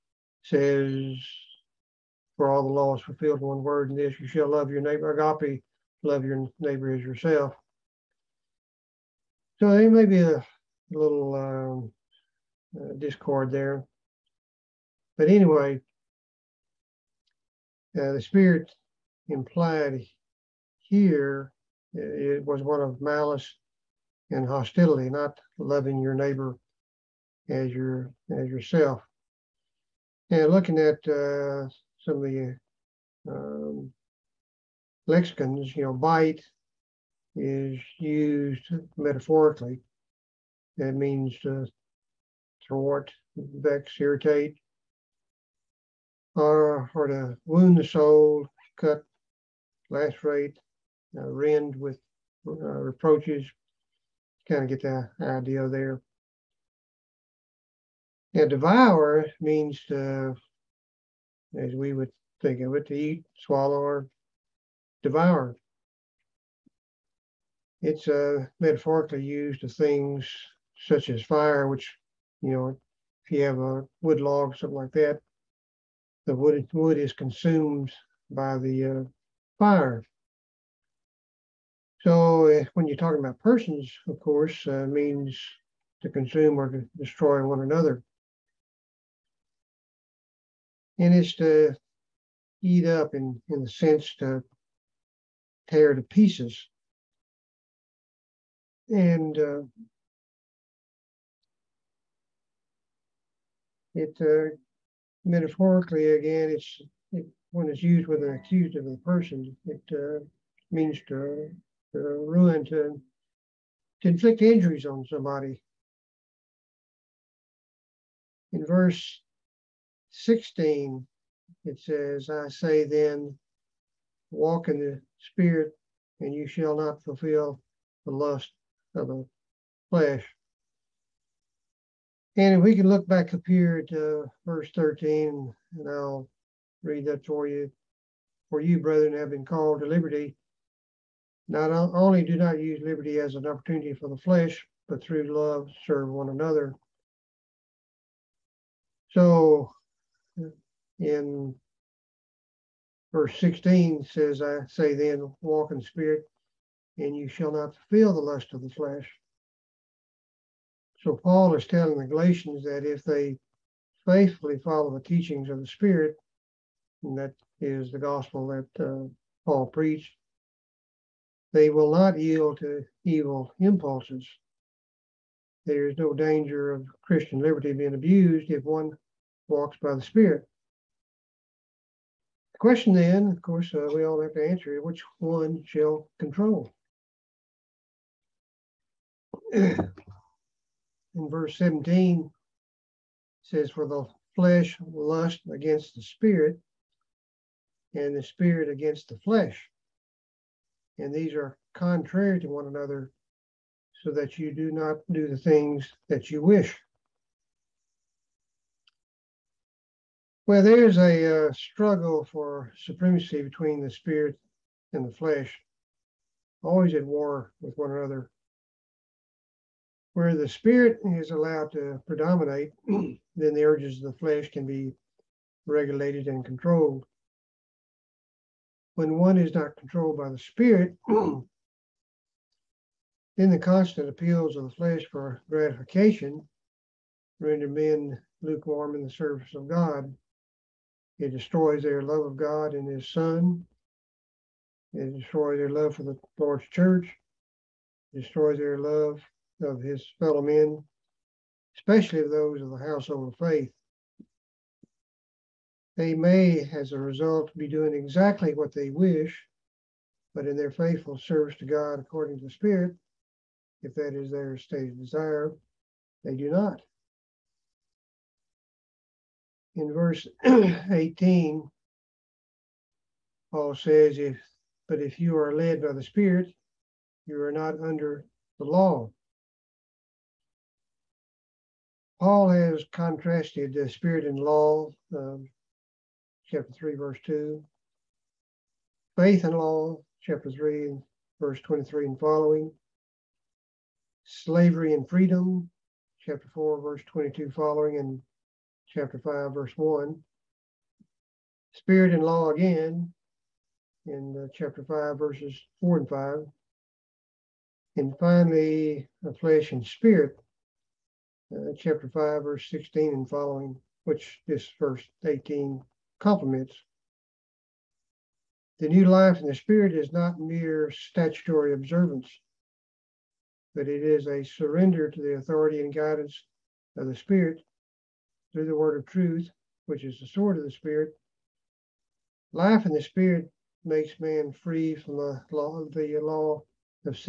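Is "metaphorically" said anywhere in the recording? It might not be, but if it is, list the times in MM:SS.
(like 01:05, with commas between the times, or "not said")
00:38, 01:08, 01:45.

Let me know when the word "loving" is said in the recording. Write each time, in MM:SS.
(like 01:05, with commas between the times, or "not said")
00:25.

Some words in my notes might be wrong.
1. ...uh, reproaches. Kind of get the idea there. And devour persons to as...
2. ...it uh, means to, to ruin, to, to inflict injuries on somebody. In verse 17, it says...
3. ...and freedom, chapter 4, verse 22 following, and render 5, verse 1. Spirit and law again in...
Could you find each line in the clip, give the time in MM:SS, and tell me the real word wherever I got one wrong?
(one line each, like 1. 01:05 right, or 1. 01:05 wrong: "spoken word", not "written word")
1. 00:52 wrong: "means", not "persons"
2. 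01:49 wrong: "16", not "17"
3. 04:54 wrong: "chapter", not "render".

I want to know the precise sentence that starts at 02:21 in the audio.
Not only do not use liberty as an opportunity for the flesh, but through love serve one another.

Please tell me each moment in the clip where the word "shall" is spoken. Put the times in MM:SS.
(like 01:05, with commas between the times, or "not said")
00:04, 02:06, 02:37, 03:05.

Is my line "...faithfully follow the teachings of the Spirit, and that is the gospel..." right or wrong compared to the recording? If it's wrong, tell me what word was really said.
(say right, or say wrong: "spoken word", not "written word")
right.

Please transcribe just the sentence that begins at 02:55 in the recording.
There is no danger of Christian liberty being abused if one walks by the Spirit.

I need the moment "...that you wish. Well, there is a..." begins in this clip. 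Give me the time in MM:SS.
03:26.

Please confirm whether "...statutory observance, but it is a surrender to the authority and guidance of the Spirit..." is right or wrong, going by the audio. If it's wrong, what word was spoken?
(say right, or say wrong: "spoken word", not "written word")
right.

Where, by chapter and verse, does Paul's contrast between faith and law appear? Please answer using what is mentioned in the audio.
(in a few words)
Chapter 3, verse 23.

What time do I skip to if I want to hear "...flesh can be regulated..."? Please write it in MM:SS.
03:44.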